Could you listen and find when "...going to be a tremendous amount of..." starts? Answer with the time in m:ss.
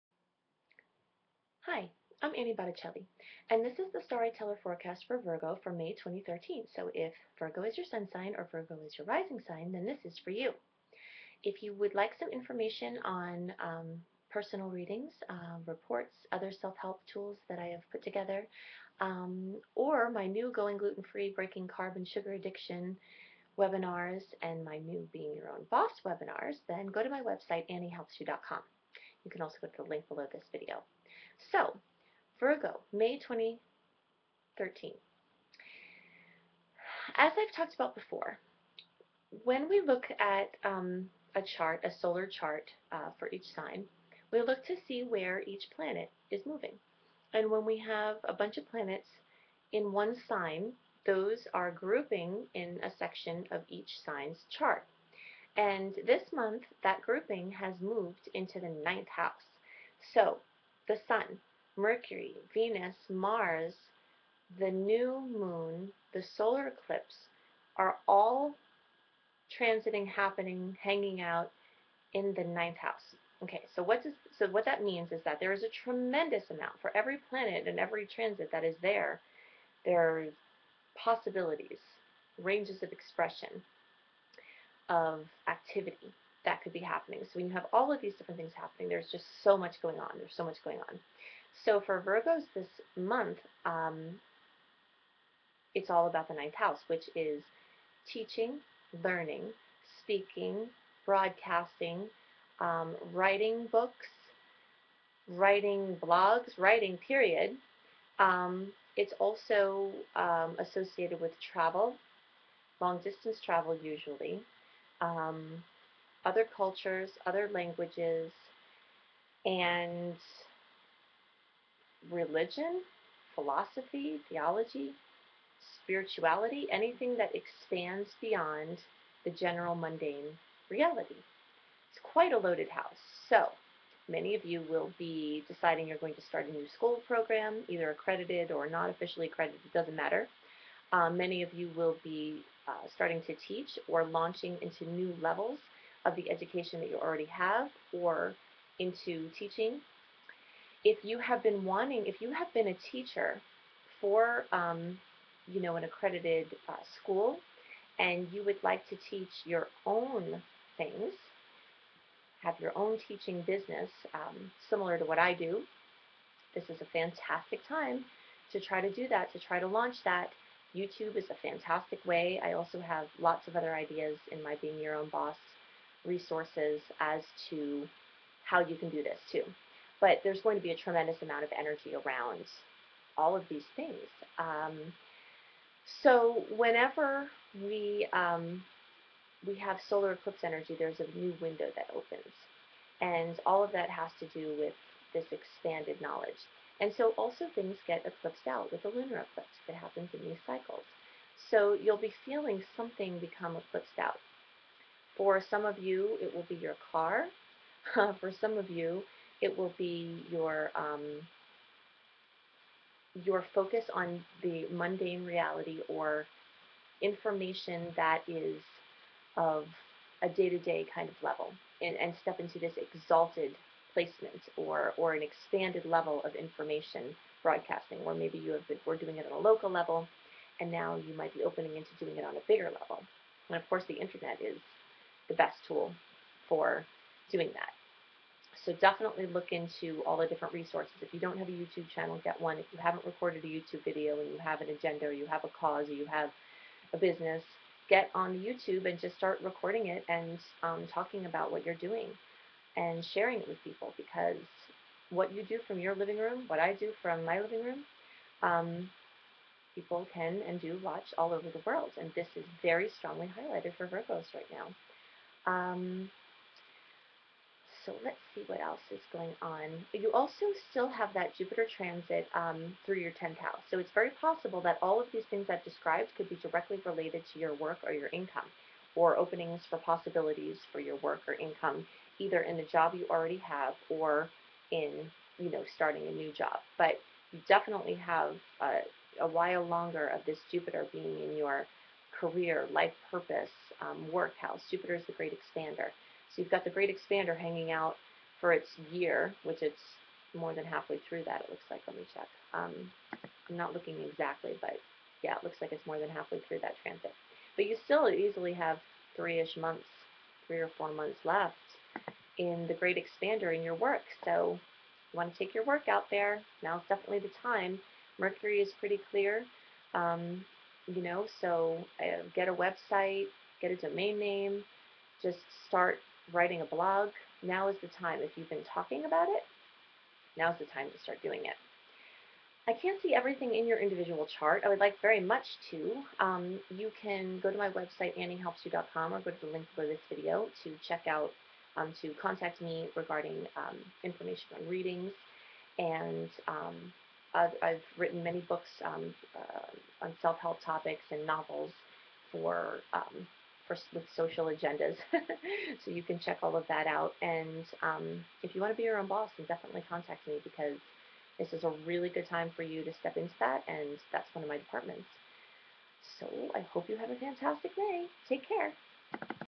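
3:00.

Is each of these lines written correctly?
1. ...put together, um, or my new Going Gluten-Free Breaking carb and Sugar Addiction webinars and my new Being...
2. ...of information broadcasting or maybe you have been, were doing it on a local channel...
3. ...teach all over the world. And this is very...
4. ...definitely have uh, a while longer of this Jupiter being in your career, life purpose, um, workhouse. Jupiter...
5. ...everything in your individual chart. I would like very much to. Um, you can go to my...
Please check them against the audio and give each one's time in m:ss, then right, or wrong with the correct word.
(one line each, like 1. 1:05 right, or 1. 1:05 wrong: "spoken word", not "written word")
1. 0:17 right
2. 3:46 wrong: "level", not "channel"
3. 4:20 wrong: "watch", not "teach"
4. 4:47 right
5. 5:33 right.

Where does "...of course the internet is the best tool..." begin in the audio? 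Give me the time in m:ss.
3:53.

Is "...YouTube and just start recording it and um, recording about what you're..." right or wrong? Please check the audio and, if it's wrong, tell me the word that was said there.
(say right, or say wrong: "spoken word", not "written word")
wrong: "talking", not "recording".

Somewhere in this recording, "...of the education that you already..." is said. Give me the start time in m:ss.
2:26.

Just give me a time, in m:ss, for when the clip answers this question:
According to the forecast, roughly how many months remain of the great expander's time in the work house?
5:10.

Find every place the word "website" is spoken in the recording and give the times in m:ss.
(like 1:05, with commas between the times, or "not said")
0:27, 5:22, 5:37.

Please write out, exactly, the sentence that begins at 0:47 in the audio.
And when we have a bunch of planets in one sign, those are grouping in a section of each sign's chart.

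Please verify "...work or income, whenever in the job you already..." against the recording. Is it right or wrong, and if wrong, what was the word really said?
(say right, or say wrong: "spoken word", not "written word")
wrong: "either", not "whenever".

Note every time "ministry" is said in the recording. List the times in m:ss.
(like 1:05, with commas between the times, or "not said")
not said.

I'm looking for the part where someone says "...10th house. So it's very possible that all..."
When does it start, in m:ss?
4:33.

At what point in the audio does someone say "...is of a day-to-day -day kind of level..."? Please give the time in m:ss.
3:38.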